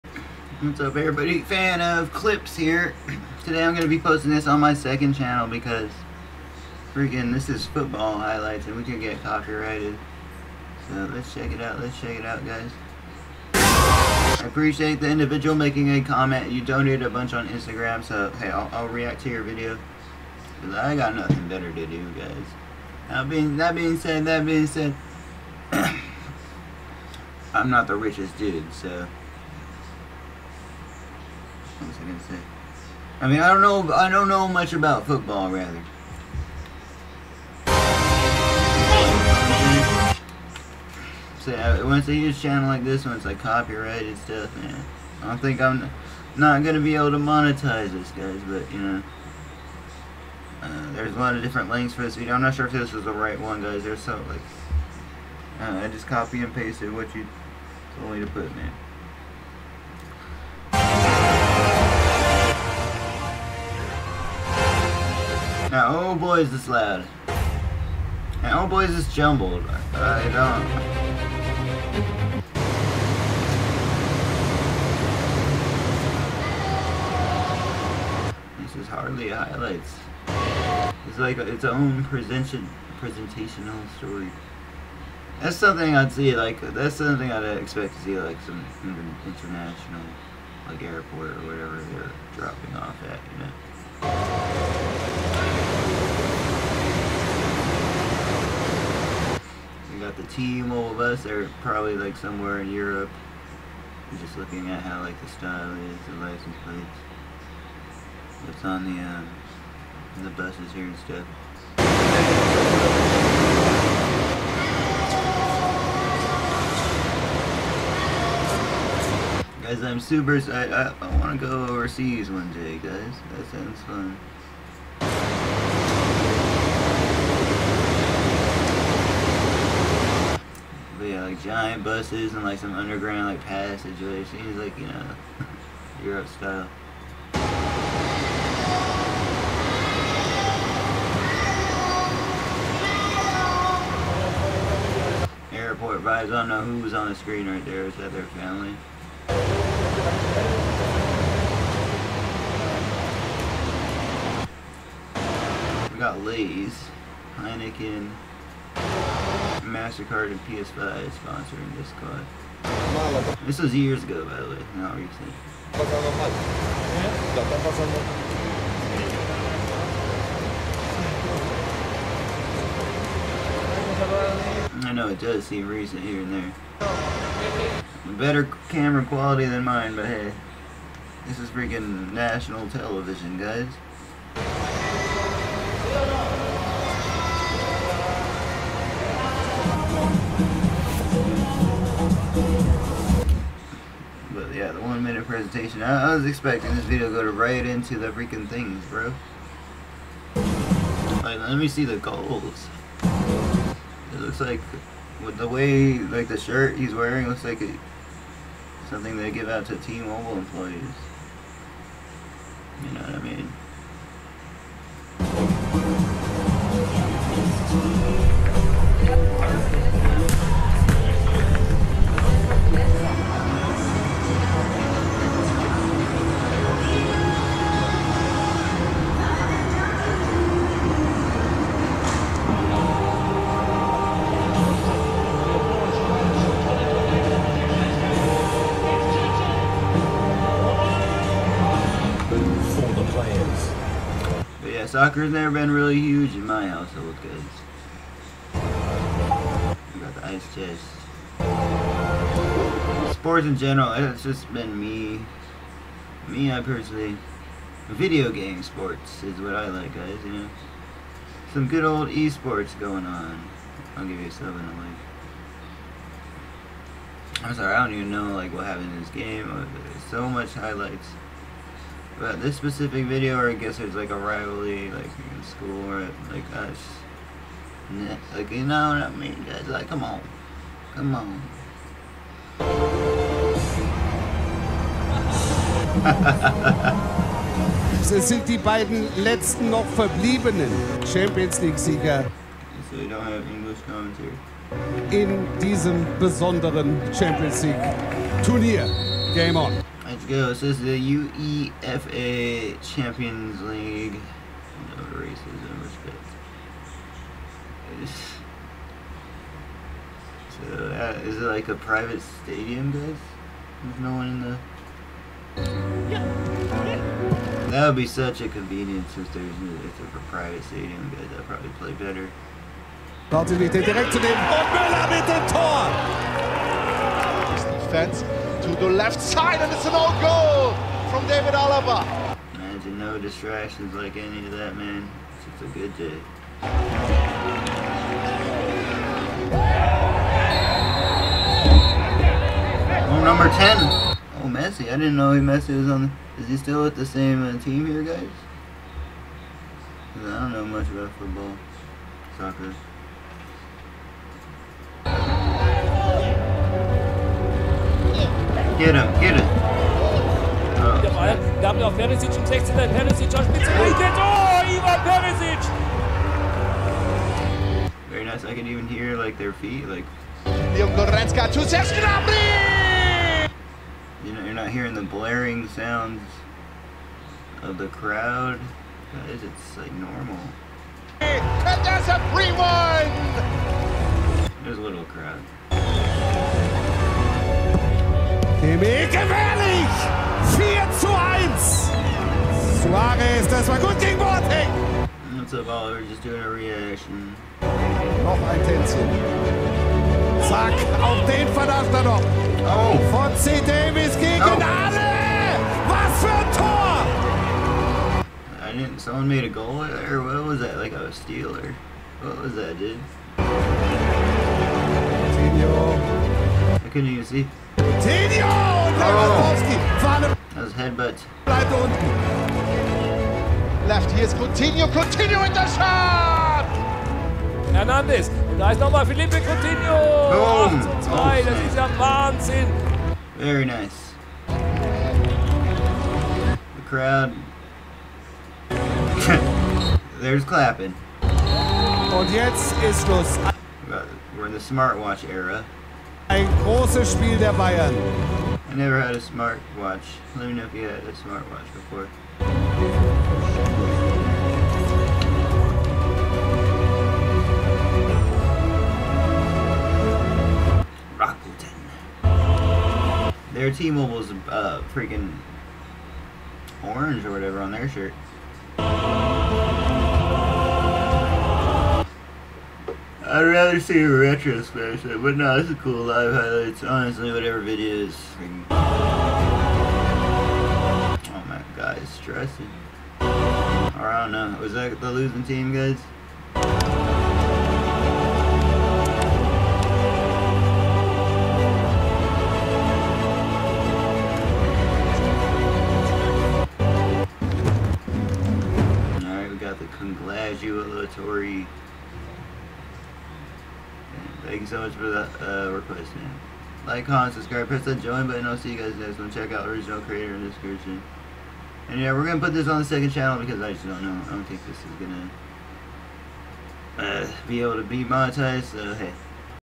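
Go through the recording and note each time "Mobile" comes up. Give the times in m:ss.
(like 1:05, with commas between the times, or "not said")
3:29, 7:43.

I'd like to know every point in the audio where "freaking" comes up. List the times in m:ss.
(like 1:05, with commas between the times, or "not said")
0:06, 3:01, 3:18, 7:44.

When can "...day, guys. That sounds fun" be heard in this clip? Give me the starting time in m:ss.
2:02.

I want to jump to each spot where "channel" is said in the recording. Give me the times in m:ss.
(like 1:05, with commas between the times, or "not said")
0:05, 0:42, 8:33.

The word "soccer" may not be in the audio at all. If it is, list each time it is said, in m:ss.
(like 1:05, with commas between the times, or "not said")
4:04, 5:52.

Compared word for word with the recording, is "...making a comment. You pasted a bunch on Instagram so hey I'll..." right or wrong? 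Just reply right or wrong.
wrong.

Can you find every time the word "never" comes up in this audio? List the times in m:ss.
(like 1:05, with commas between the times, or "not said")
4:05, 7:28.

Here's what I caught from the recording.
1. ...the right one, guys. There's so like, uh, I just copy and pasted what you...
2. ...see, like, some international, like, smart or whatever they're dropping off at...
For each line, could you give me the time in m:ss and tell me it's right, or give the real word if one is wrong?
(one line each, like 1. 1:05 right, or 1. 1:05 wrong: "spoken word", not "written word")
1. 0:53 right
2. 1:28 wrong: "airport", not "smart".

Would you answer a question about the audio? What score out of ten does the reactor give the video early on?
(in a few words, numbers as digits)
7.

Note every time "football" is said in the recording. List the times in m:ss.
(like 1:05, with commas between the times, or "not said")
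0:07, 0:35, 5:51.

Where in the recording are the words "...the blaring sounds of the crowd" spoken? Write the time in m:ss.
6:14.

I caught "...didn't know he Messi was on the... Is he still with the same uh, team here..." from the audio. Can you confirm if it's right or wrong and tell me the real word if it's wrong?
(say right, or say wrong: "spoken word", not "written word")
right.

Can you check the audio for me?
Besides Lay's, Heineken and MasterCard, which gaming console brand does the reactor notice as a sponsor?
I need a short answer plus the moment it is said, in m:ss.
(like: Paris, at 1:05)
PS5, at 2:40.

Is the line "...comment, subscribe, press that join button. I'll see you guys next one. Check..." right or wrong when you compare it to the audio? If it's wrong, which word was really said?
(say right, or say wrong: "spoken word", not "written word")
right.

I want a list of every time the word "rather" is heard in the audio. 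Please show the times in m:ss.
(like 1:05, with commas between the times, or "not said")
0:35, 7:53.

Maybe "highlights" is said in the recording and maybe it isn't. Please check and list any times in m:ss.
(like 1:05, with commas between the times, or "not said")
0:08, 1:19, 4:30, 7:56.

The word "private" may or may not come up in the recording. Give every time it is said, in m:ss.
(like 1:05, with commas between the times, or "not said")
5:11, 5:20.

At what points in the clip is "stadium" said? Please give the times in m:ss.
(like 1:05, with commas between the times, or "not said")
5:12, 5:20.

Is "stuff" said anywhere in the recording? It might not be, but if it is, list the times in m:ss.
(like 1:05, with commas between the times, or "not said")
0:44, 1:50.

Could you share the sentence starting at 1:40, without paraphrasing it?
team, all of us, are probably like somewhere in Europe.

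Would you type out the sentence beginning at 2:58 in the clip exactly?
Better camera quality than mine, but hey.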